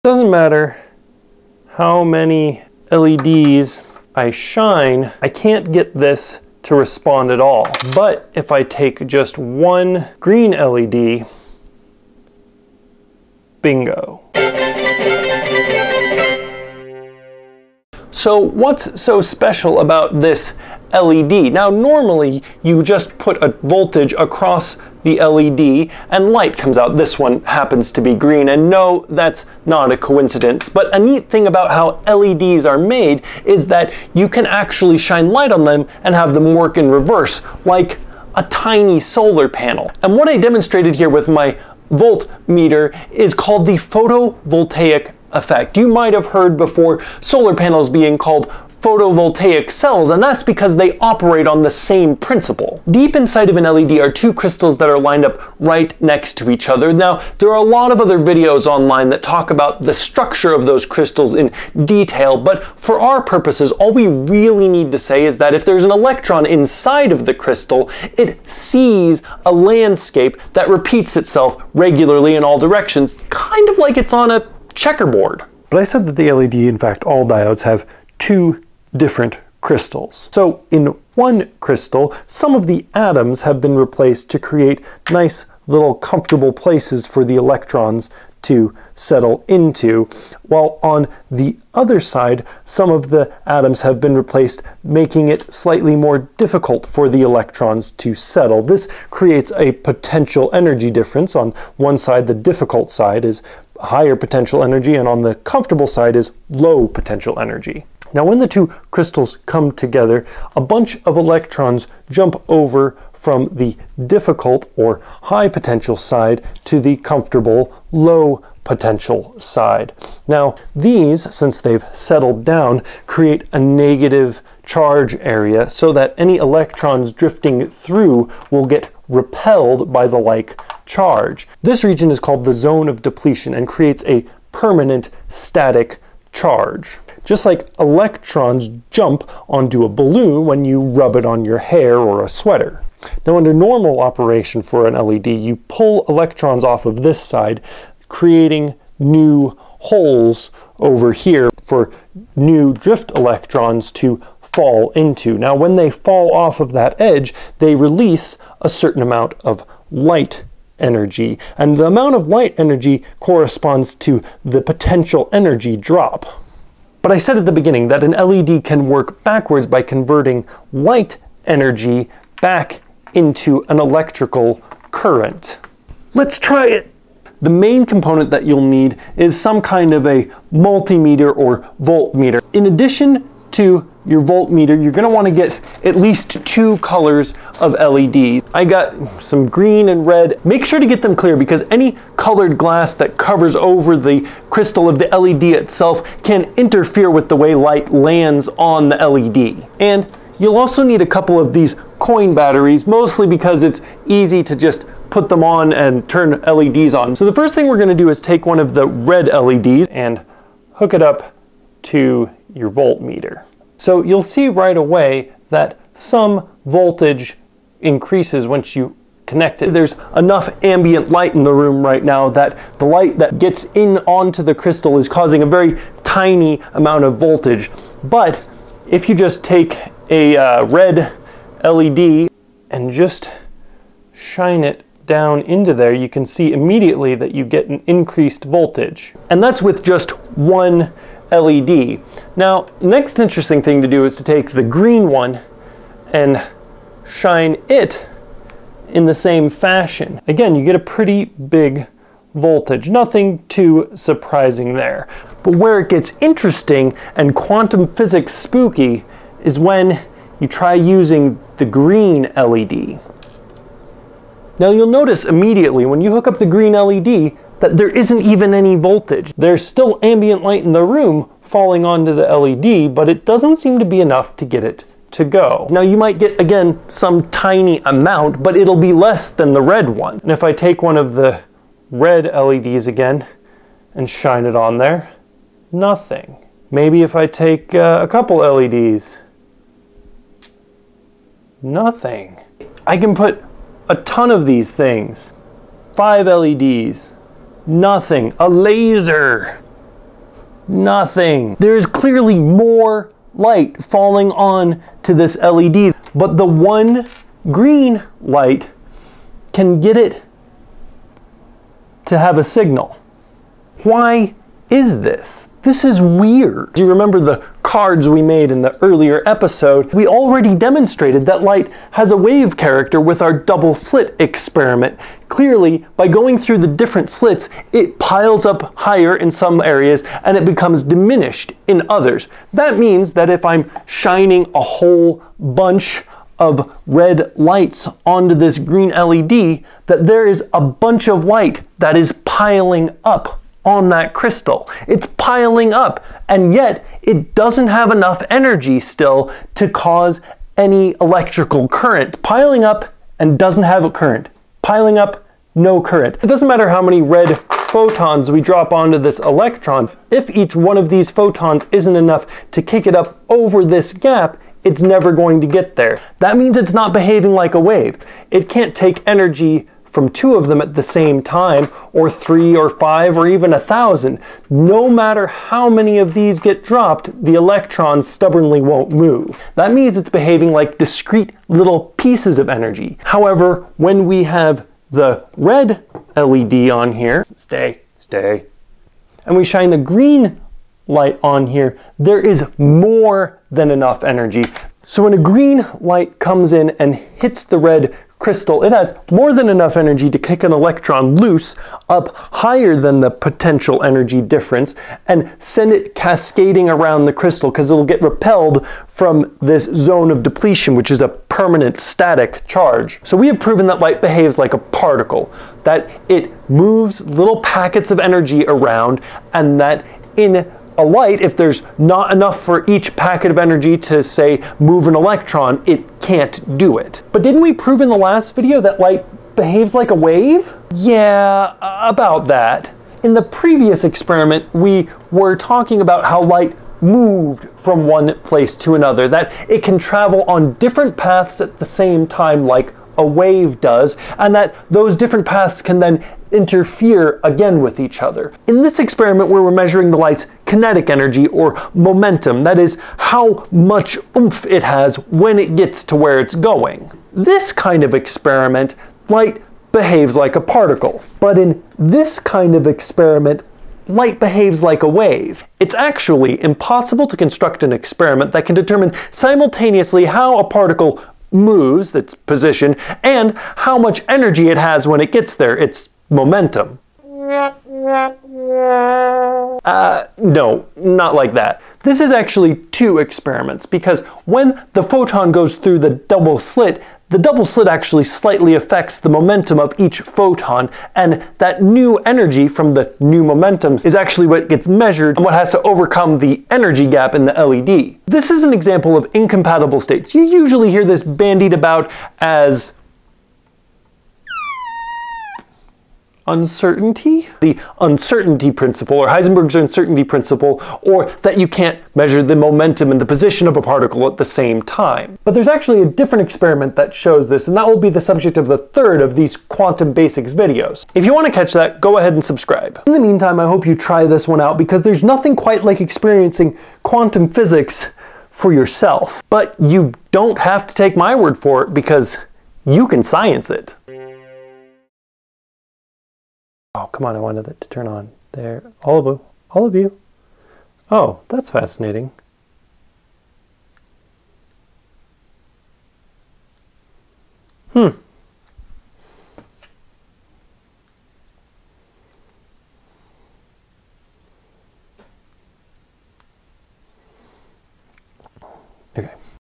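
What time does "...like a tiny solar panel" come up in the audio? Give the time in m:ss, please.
0:37.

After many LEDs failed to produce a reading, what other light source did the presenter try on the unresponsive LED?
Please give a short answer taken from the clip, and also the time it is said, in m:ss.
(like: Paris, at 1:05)
a laser, at 4:58.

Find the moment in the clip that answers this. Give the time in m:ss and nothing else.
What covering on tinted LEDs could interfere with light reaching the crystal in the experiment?
3:12.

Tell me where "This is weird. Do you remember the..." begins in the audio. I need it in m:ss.
5:15.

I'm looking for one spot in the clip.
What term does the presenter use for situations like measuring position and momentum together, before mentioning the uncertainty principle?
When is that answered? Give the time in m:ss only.
8:19.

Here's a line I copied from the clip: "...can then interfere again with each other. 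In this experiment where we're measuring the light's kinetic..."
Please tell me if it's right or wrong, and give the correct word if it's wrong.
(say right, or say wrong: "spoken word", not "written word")
right.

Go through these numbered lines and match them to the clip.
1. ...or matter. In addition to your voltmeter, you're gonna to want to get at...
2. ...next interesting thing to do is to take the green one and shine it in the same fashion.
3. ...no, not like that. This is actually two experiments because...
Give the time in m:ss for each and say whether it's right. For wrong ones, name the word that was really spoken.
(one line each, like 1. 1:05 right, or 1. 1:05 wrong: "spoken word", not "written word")
1. 3:01 wrong: "voltmeter", not "matter"
2. 4:02 right
3. 8:00 right.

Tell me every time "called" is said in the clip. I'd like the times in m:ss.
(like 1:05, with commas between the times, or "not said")
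0:43, 0:48, 2:12.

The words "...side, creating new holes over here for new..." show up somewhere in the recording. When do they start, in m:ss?
2:27.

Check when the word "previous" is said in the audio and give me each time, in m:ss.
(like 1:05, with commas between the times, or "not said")
7:13.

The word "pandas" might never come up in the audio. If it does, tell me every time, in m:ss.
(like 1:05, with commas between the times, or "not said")
not said.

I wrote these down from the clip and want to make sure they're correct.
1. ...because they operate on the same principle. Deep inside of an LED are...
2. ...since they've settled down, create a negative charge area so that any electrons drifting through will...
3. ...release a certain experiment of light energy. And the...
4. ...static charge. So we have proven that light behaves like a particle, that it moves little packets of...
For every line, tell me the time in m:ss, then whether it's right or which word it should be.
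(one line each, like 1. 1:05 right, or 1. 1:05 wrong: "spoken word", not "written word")
1. 0:50 right
2. 2:01 right
3. 2:37 wrong: "amount", not "experiment"
4. 6:51 right.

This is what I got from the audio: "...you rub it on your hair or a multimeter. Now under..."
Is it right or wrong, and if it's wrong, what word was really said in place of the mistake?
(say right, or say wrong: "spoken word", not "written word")
wrong: "sweater", not "multimeter".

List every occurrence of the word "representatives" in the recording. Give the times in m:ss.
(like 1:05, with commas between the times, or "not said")
not said.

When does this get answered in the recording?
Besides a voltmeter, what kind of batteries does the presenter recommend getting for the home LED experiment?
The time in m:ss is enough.
3:21.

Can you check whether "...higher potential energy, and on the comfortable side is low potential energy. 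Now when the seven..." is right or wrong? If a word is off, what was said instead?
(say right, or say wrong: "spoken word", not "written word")
wrong: "two", not "seven".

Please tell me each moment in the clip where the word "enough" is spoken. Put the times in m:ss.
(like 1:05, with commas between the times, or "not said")
3:40, 4:34, 5:47, 6:01, 6:33, 6:39, 7:02.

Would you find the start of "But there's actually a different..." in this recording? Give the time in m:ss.
8:35.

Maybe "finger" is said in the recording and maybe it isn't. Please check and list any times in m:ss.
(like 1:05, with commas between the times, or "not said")
not said.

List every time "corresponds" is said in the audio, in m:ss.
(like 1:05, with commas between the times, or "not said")
2:43.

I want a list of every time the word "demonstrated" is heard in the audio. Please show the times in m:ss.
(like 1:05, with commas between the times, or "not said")
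0:40, 5:20.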